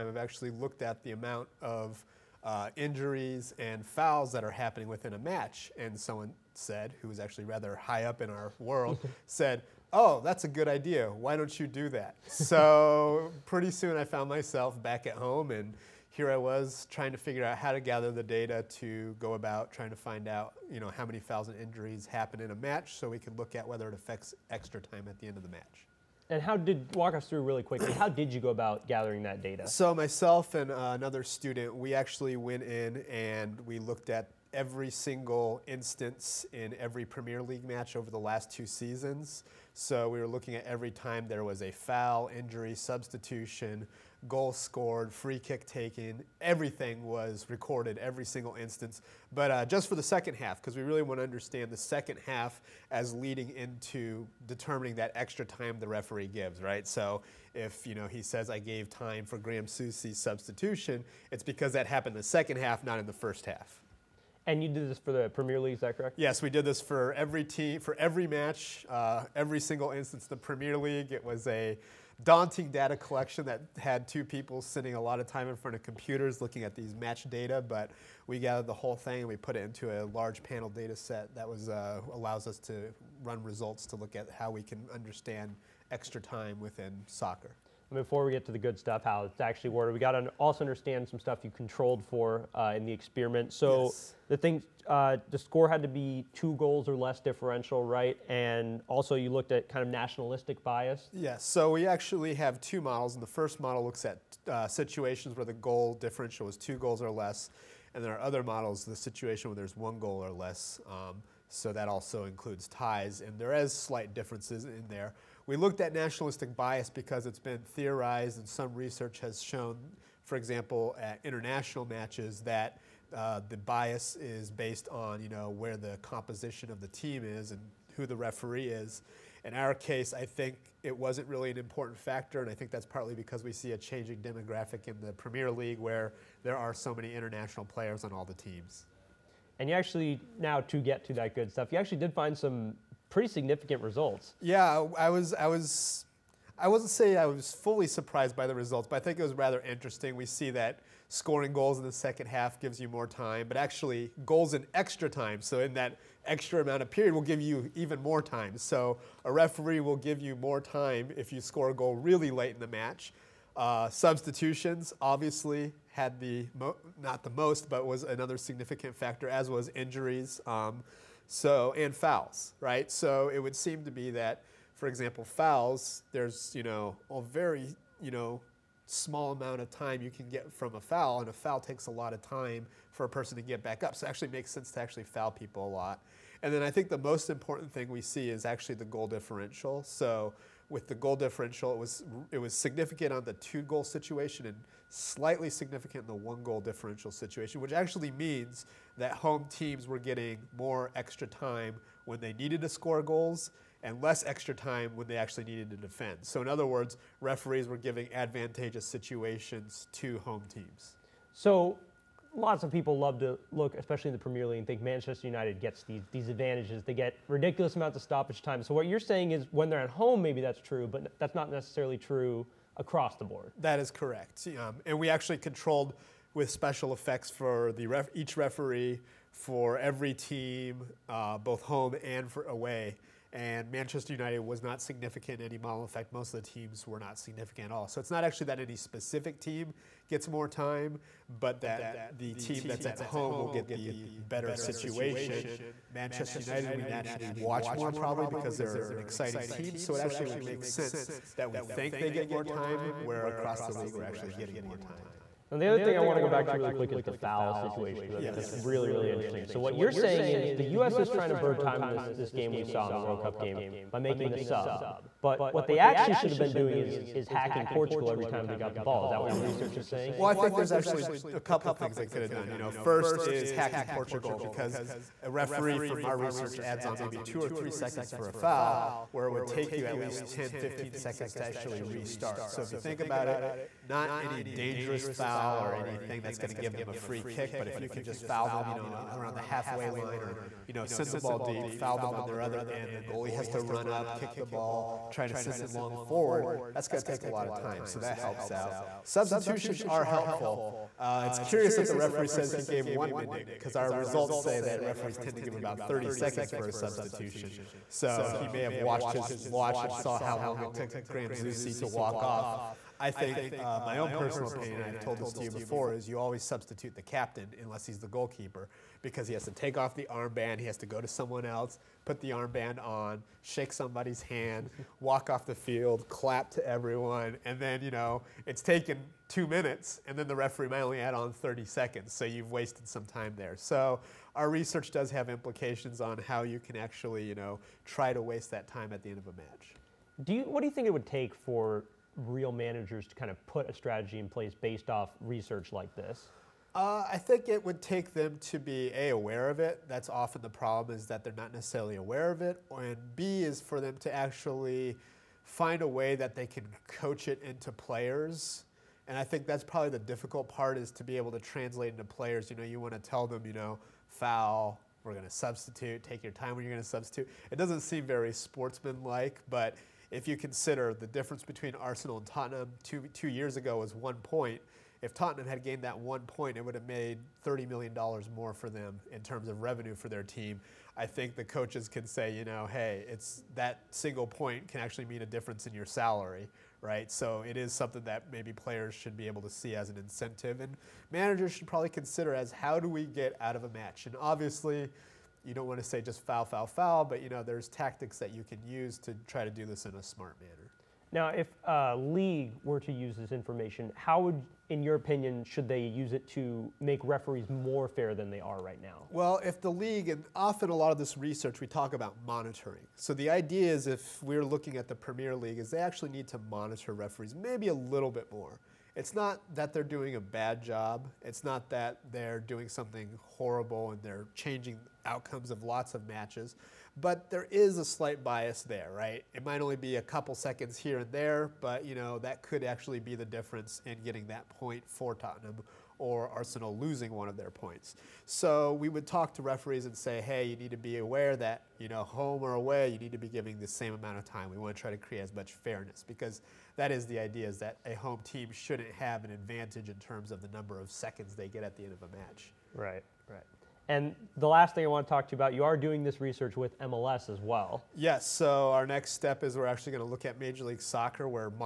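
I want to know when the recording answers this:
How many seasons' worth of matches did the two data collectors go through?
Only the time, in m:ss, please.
0:38.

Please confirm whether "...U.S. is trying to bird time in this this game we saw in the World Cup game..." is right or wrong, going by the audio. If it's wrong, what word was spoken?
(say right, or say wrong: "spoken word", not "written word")
right.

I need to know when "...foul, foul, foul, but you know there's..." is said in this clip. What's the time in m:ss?
6:36.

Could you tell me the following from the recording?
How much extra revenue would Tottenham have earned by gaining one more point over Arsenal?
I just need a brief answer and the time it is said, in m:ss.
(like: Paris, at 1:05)
$30 million, at 6:17.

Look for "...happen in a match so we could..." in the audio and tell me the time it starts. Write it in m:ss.
0:22.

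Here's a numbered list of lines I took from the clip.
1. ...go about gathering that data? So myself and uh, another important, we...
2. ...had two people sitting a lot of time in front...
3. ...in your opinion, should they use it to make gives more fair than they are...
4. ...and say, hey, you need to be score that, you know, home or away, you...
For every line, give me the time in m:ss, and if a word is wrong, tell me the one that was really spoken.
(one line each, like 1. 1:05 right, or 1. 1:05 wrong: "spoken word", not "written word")
1. 0:28 wrong: "student", not "important"
2. 1:13 right
3. 6:44 wrong: "referees", not "gives"
4. 7:19 wrong: "aware", not "score".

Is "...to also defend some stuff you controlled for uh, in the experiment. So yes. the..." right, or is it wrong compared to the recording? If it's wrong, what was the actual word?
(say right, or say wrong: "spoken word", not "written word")
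wrong: "understand", not "defend".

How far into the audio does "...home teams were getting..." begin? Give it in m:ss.
3:19.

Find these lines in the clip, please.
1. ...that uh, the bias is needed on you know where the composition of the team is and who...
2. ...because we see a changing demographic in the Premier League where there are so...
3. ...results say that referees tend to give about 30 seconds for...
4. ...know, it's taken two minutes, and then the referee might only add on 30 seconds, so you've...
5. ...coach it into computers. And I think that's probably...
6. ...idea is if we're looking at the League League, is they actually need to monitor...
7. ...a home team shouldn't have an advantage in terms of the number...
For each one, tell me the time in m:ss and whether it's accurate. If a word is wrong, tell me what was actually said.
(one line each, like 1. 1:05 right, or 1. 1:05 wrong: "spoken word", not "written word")
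1. 2:02 wrong: "based", not "needed"
2. 2:13 right
3. 5:03 right
4. 5:27 right
5. 5:56 wrong: "players", not "computers"
6. 6:53 wrong: "Premier", not "League"
7. 7:27 right.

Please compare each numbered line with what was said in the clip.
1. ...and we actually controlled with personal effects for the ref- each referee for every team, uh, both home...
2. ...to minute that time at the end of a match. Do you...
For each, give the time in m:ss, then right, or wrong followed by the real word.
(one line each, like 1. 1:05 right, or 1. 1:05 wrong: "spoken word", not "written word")
1. 3:44 wrong: "special", not "personal"
2. 5:38 wrong: "waste", not "minute".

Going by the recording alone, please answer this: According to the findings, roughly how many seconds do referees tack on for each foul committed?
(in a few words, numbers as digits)
2 or 3 seconds.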